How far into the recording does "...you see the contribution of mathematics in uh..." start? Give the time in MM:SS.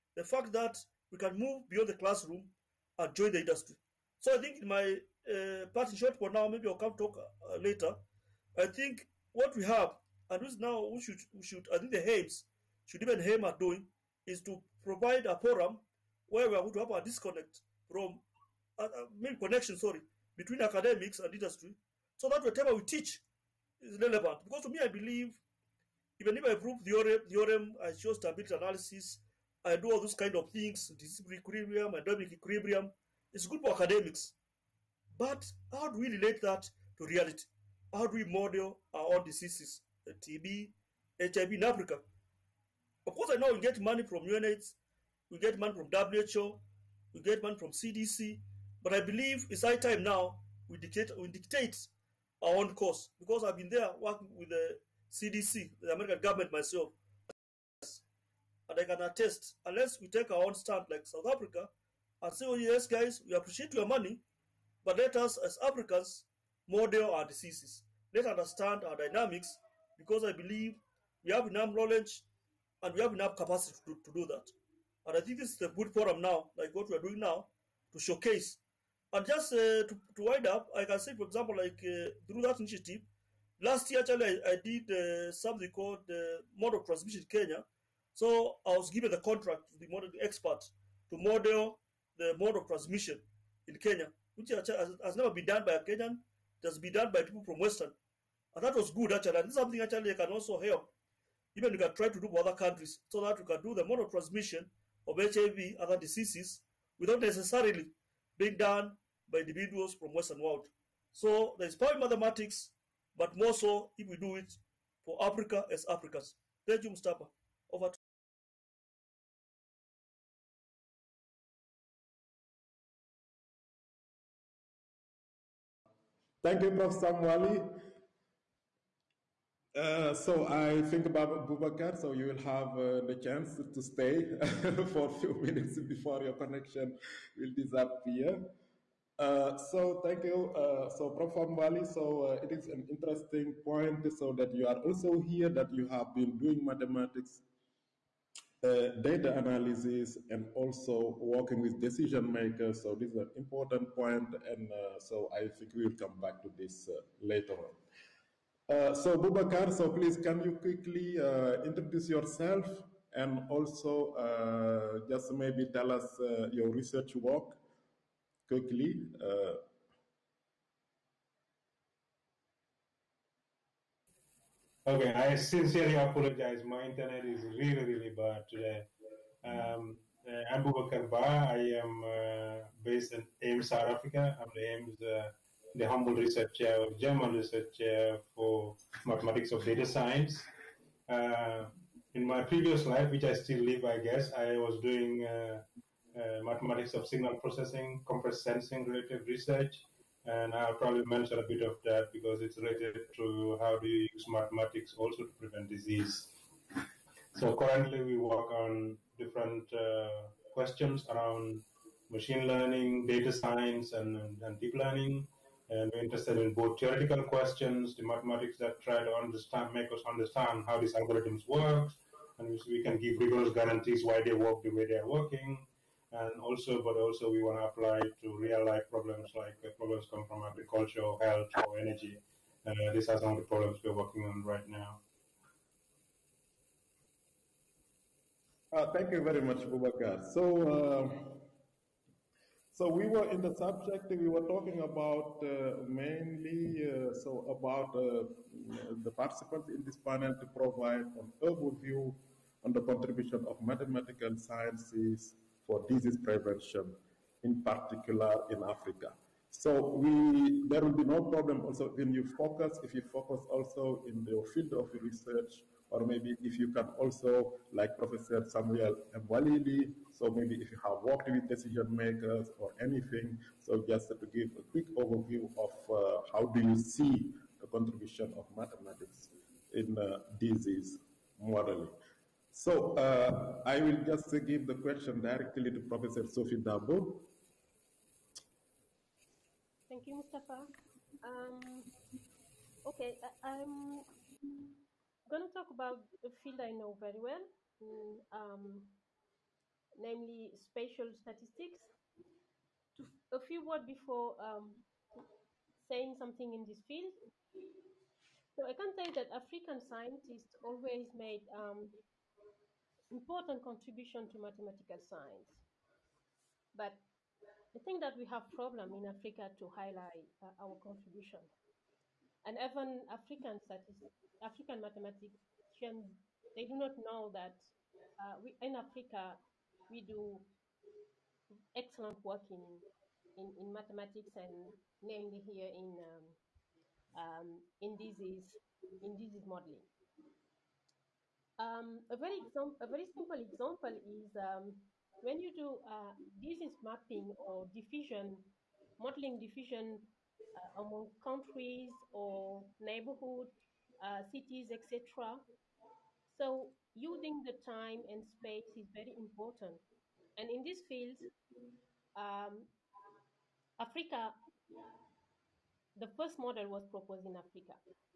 04:36.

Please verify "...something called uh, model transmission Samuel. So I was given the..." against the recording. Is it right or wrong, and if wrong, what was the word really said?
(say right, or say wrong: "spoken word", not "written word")
wrong: "Kenya", not "Samuel".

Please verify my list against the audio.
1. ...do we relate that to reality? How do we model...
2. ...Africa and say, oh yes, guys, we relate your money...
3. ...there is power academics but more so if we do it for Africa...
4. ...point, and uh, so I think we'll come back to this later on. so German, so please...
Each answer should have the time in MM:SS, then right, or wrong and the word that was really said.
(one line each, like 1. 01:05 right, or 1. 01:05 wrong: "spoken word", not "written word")
1. 00:35 right
2. 01:01 wrong: "appreciate", not "relate"
3. 01:51 wrong: "mathematics", not "academics"
4. 02:33 wrong: "Bubacarr", not "German".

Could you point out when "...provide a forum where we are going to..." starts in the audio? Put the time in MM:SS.
00:14.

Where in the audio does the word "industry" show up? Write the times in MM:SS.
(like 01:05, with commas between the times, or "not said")
00:03, 00:21.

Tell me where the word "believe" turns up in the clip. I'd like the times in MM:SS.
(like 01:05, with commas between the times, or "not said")
00:24, 00:49, 01:10.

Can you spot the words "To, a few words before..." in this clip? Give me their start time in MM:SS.
05:02.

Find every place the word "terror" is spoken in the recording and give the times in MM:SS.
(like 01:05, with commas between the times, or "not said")
not said.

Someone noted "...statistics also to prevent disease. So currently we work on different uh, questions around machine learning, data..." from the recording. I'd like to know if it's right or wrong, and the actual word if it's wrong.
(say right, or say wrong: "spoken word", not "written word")
wrong: "mathematics", not "statistics".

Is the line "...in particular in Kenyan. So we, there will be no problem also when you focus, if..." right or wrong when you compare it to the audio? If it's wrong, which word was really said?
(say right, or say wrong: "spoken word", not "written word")
wrong: "Africa", not "Kenyan".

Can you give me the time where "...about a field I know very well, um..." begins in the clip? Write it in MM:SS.
04:55.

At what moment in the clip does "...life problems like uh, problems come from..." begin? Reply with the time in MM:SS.
03:48.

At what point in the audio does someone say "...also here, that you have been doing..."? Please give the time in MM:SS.
02:24.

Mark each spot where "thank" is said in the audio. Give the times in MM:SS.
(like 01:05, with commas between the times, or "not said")
01:56, 02:06, 02:20, 03:58, 04:49.